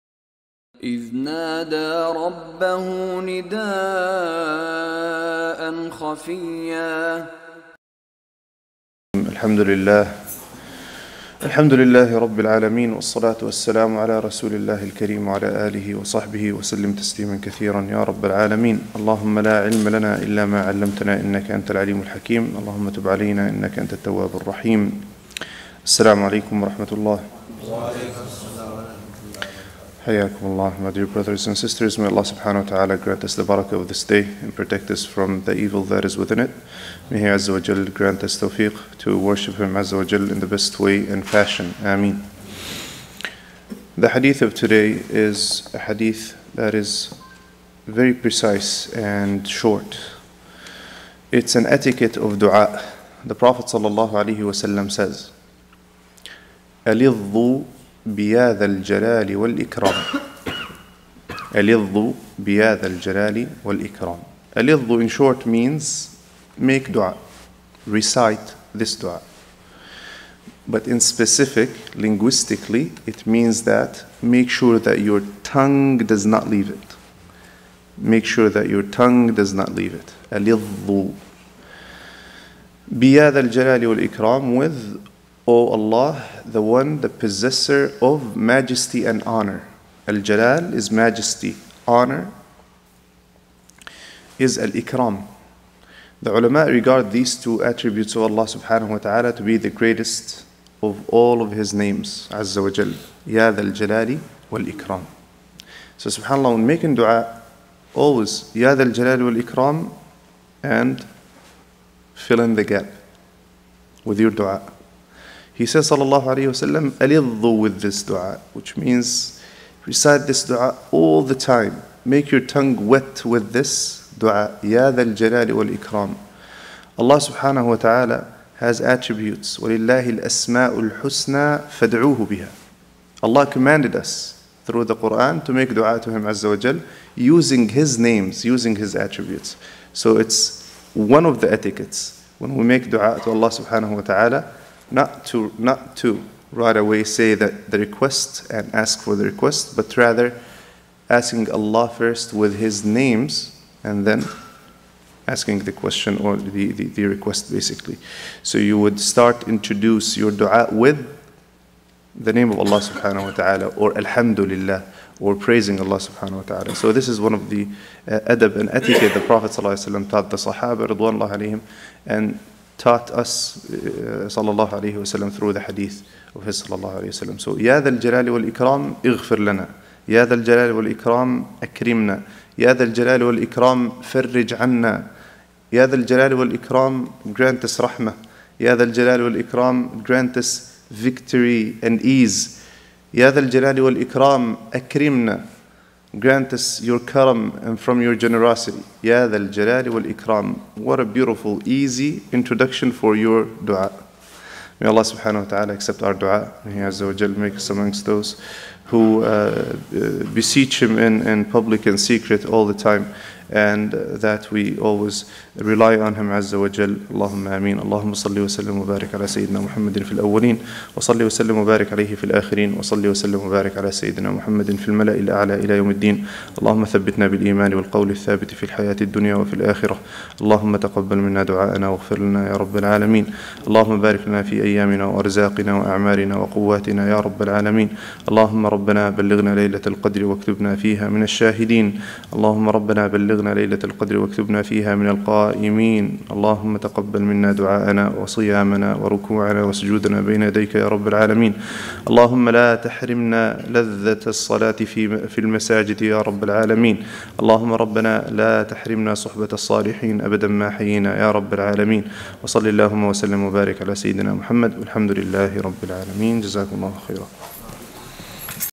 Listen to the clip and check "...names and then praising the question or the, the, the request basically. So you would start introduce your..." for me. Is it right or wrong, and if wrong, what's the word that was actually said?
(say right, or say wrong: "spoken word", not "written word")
wrong: "asking", not "praising".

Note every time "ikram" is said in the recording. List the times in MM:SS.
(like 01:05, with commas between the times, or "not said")
01:34, 01:44, 01:49, 02:05, 03:20.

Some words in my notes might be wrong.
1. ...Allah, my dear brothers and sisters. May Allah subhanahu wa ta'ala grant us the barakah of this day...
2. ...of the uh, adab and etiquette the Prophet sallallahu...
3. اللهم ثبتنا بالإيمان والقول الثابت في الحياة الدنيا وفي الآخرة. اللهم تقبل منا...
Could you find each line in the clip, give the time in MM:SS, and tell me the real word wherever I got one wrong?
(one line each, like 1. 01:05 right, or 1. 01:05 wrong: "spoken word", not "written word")
1. 00:30 right
2. 02:47 right
3. 03:46 right.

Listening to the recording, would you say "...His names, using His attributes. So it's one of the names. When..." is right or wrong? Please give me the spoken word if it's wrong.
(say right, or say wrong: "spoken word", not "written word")
wrong: "etiquettes", not "names".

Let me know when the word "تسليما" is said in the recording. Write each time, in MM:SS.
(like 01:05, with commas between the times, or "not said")
00:16.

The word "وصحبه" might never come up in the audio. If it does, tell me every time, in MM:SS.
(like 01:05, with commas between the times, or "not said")
00:15.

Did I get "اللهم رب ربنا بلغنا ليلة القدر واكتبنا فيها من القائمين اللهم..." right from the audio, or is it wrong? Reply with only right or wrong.
wrong.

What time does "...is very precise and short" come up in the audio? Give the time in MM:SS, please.
00:46.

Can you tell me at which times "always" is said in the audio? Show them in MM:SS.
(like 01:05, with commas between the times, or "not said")
01:47, 03:34.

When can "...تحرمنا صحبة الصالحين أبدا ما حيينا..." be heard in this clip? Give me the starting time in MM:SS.
04:18.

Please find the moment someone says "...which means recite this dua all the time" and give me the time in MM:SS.
01:58.